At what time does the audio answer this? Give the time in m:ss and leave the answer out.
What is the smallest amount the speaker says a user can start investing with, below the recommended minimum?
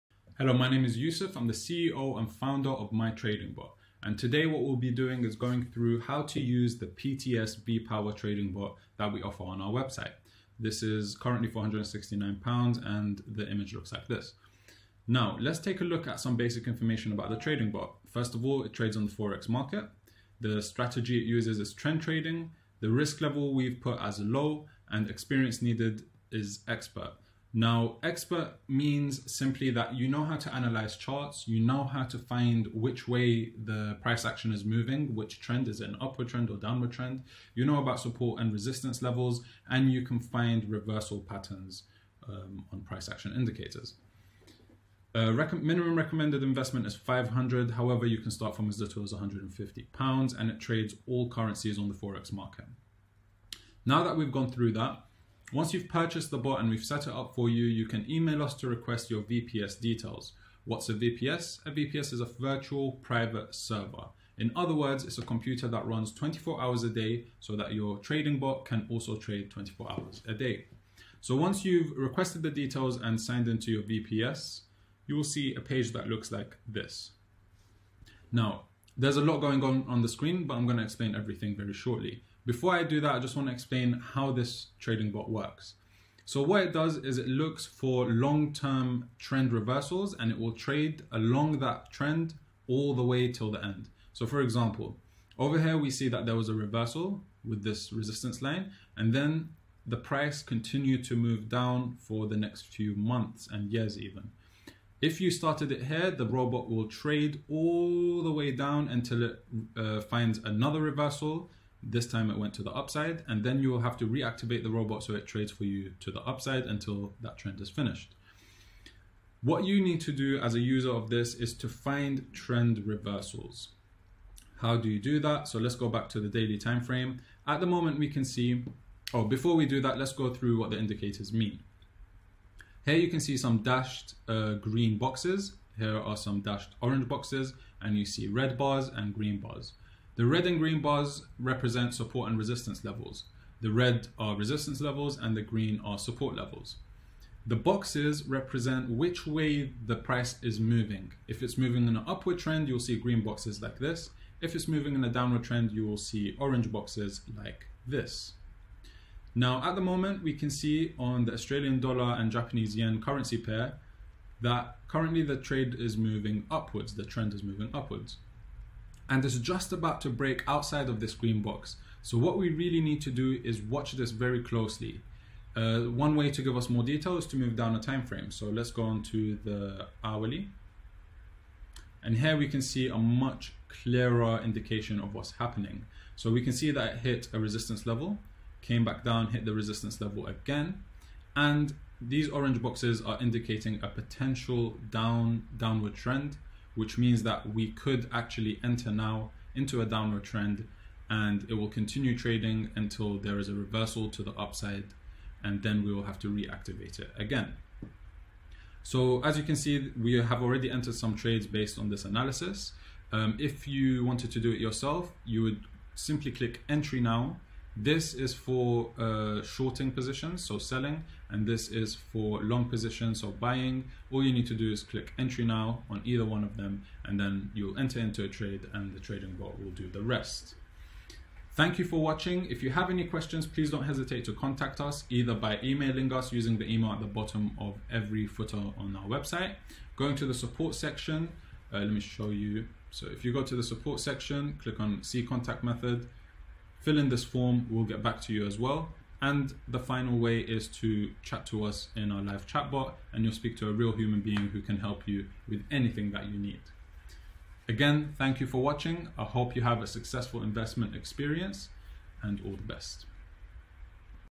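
0:49.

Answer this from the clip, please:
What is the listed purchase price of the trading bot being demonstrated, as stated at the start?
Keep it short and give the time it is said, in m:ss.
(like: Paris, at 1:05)
469 pounds, at 0:11.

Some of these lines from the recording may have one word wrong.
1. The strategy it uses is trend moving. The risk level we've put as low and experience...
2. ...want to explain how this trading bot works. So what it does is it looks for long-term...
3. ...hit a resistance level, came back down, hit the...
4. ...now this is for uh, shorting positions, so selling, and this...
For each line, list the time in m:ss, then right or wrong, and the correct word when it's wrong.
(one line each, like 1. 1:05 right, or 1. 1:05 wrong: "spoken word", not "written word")
1. 0:20 wrong: "trading", not "moving"
2. 1:23 right
3. 3:06 right
4. 3:37 right.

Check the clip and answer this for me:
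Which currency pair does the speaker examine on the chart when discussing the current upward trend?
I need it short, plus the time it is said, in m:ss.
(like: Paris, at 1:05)
Australian dollar and Japanese yen, at 2:41.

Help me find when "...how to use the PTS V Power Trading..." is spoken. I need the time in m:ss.
0:06.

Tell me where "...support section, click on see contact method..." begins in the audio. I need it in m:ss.
4:03.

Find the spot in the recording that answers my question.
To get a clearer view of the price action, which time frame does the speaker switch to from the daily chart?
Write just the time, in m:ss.
3:00.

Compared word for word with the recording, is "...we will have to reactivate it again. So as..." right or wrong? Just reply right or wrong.
right.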